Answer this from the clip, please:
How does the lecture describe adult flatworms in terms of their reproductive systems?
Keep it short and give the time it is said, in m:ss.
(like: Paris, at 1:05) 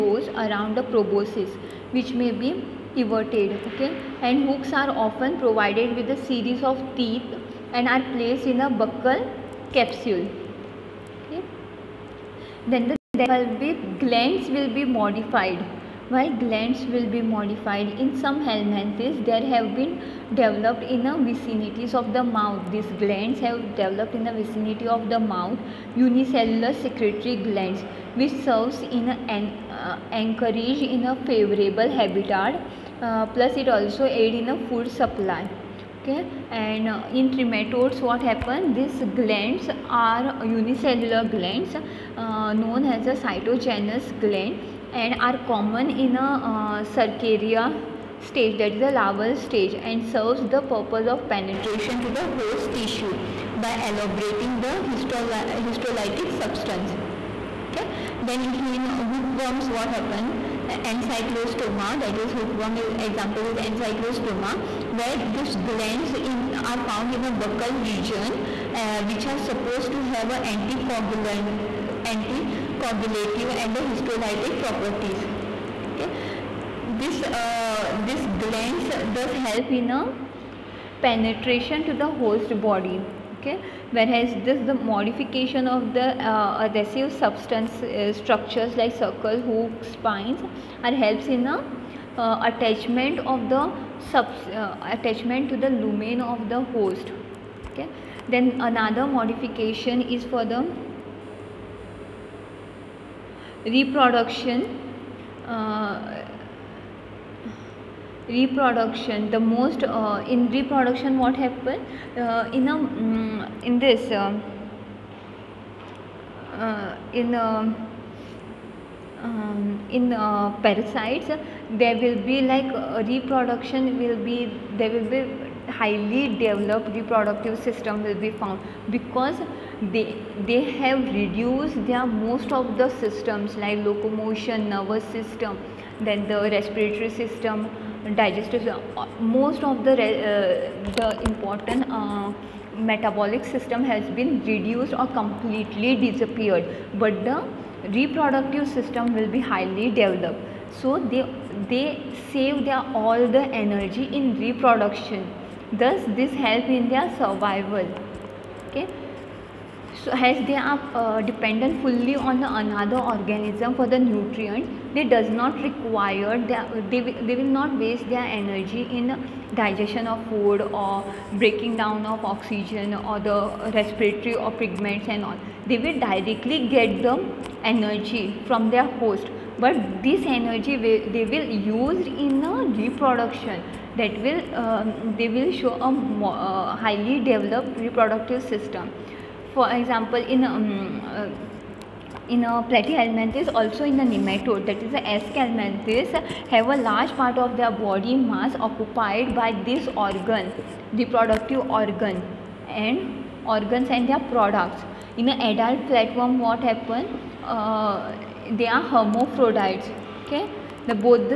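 hermaphrodites, at 3:28.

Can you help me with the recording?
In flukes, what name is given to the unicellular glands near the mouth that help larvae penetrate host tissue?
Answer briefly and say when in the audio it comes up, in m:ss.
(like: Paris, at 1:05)
cystogenous gland, at 0:43.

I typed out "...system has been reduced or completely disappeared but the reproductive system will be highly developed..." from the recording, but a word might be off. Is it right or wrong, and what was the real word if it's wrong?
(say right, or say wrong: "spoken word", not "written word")
right.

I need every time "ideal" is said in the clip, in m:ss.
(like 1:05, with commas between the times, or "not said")
not said.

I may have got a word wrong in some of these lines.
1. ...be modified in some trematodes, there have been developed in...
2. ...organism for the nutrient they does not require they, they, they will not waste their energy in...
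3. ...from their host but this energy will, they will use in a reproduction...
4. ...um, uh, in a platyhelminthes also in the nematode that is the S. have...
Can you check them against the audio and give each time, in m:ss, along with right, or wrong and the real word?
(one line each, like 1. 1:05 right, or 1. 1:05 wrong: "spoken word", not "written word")
1. 0:17 wrong: "helminthes", not "trematodes"
2. 2:42 right
3. 2:58 right
4. 3:10 right.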